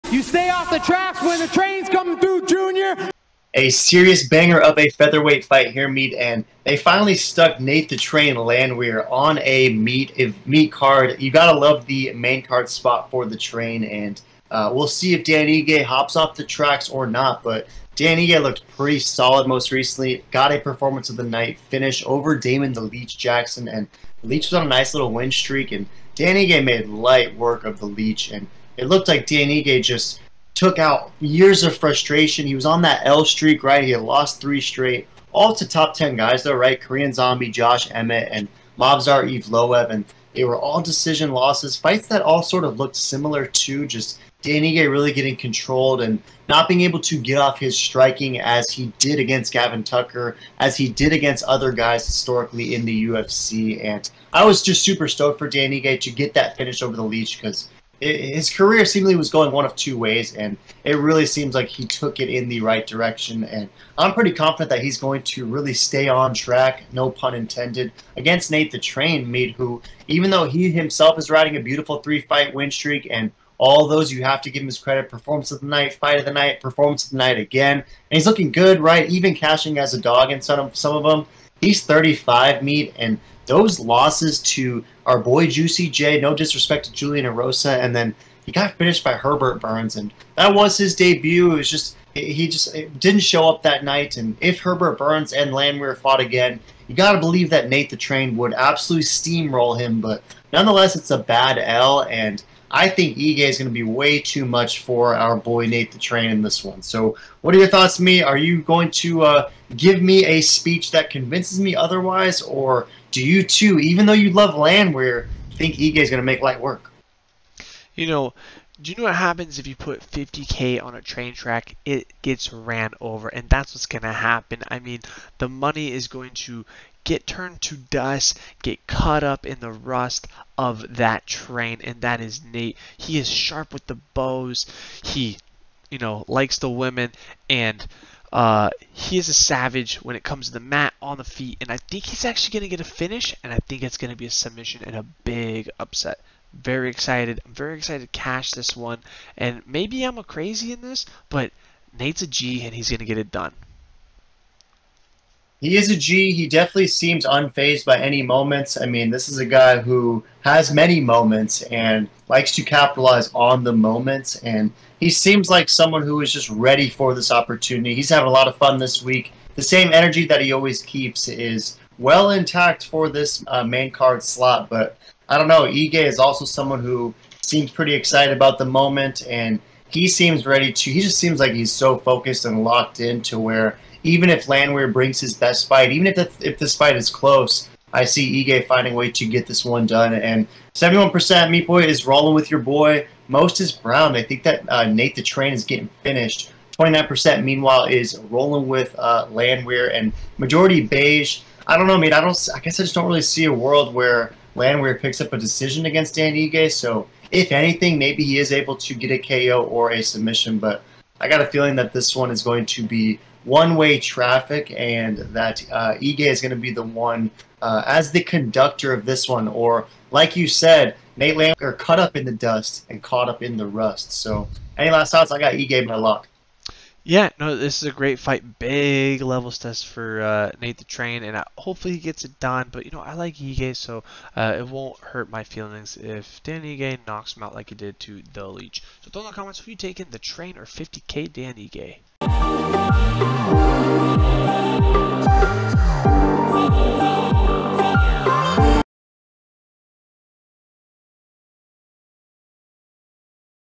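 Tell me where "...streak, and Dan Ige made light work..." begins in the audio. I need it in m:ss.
0:25.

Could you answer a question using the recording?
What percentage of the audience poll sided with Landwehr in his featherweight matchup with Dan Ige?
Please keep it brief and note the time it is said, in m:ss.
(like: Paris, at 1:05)
29%, at 3:16.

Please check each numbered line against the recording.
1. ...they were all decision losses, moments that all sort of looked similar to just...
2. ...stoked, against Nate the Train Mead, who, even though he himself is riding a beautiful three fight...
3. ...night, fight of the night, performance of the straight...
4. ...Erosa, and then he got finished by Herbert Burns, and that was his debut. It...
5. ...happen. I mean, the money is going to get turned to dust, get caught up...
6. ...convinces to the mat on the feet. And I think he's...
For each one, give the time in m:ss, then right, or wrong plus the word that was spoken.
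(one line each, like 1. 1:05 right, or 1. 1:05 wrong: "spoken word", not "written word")
1. 0:40 wrong: "fights", not "moments"
2. 1:07 wrong: "intended", not "stoked"
3. 1:15 wrong: "night", not "straight"
4. 1:27 right
5. 2:04 right
6. 2:20 wrong: "comes", not "convinces".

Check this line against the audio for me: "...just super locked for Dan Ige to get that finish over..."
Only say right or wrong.
wrong.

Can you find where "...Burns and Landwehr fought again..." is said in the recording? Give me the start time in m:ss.
1:34.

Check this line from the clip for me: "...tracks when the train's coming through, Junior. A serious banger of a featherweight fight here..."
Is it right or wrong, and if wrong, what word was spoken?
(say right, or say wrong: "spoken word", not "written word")
right.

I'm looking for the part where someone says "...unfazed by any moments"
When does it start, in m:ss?
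2:37.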